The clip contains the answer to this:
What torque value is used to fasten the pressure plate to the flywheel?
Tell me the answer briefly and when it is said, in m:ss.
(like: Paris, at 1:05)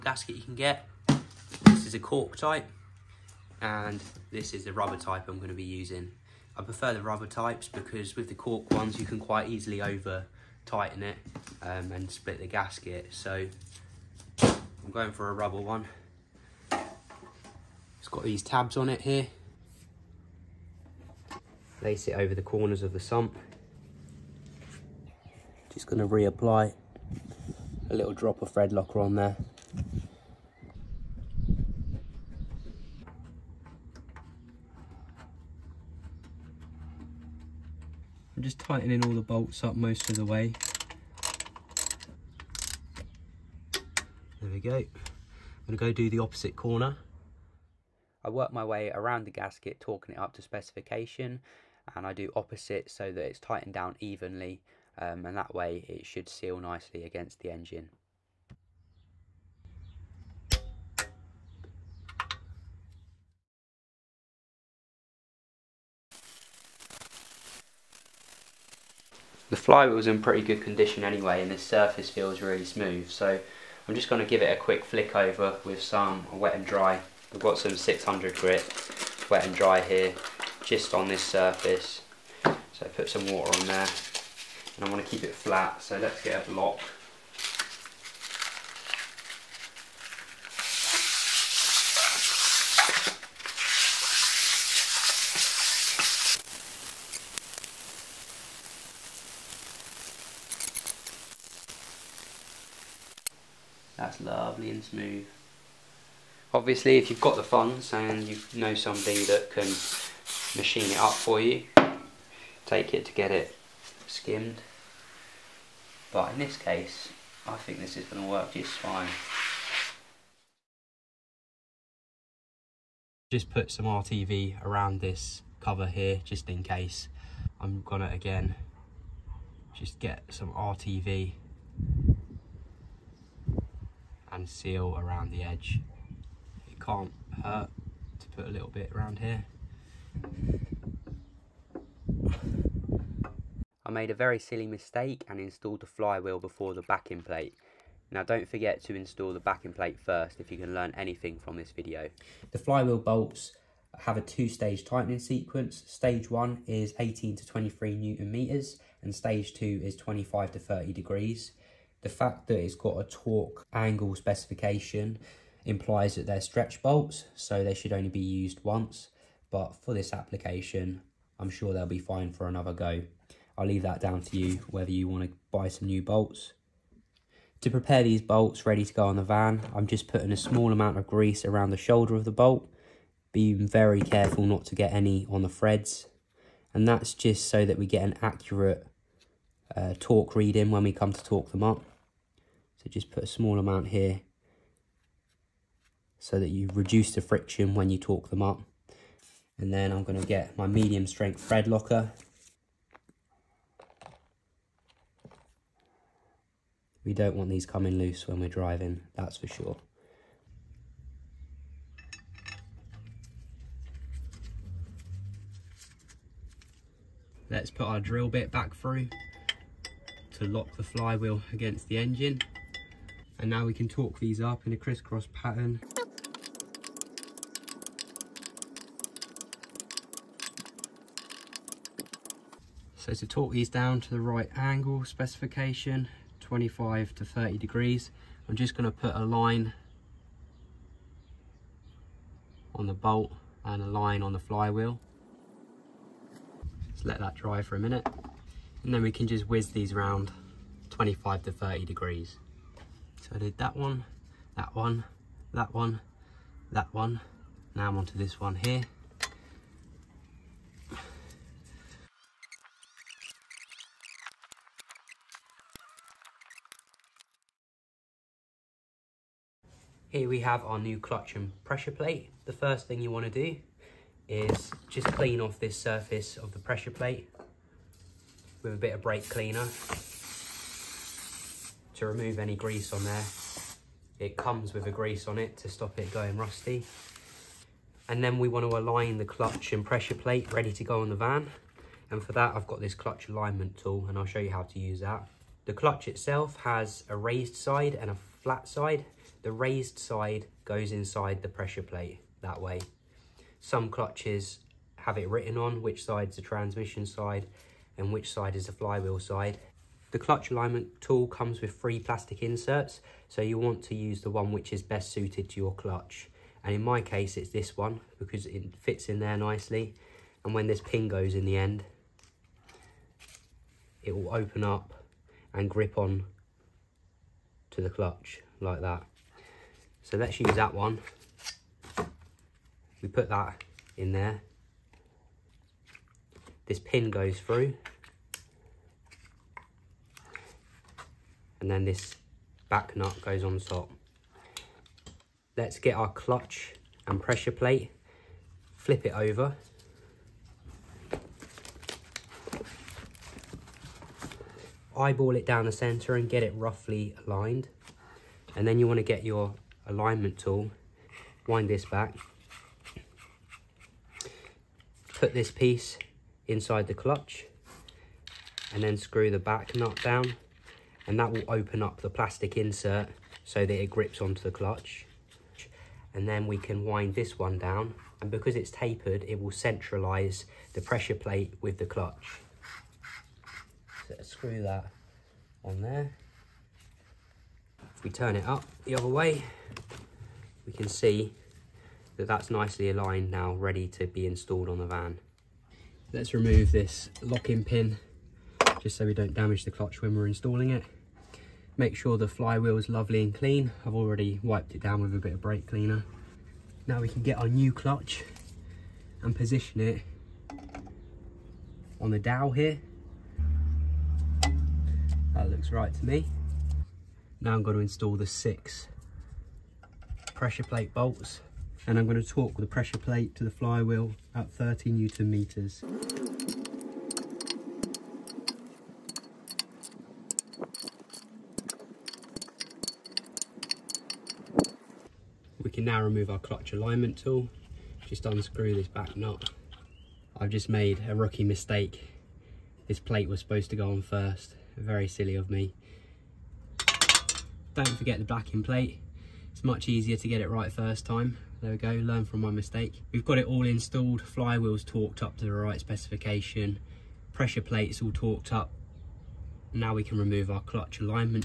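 30 newton meters, at 7:04.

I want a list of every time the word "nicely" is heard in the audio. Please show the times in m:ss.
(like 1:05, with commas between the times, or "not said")
0:56, 5:19, 6:32.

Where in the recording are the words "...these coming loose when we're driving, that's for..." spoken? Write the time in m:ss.
3:27.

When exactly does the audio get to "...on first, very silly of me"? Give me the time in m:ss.
7:23.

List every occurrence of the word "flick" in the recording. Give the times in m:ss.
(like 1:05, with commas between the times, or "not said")
1:14.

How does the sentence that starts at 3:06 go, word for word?
And that's just so that we get an accurate uh, torque reading when we come to torque them up.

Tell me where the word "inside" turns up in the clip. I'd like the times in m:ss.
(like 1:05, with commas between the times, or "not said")
5:00, 6:06.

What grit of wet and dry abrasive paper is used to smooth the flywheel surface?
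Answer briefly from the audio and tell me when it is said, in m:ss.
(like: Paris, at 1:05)
600, at 1:17.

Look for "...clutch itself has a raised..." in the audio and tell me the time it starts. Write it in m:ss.
4:55.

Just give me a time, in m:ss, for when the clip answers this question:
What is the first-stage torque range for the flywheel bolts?
2:36.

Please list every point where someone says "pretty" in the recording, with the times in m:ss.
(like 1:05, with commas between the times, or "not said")
1:10.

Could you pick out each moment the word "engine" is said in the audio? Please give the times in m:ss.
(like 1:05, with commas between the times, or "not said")
0:57, 3:41.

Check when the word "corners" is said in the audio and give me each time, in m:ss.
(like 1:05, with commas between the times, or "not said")
0:22, 0:46.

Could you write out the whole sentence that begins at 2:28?
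Now don't forget to install the backing plate first if you can learn anything from this video.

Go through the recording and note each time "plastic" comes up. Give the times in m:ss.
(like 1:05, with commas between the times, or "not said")
5:11, 6:12.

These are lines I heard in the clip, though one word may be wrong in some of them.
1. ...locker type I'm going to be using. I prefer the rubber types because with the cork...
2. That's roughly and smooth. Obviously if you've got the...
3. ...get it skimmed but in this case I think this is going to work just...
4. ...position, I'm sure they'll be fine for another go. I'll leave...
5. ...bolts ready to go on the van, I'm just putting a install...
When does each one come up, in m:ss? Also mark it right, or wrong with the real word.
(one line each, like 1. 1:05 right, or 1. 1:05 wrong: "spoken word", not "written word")
1. 0:04 wrong: "rubber", not "locker"
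2. 1:43 wrong: "lovely", not "roughly"
3. 1:53 right
4. 2:50 wrong: "application", not "position"
5. 2:58 wrong: "small", not "install".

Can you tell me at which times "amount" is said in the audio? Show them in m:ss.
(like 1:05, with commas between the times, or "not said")
3:00, 3:13.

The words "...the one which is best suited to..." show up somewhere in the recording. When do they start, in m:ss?
5:14.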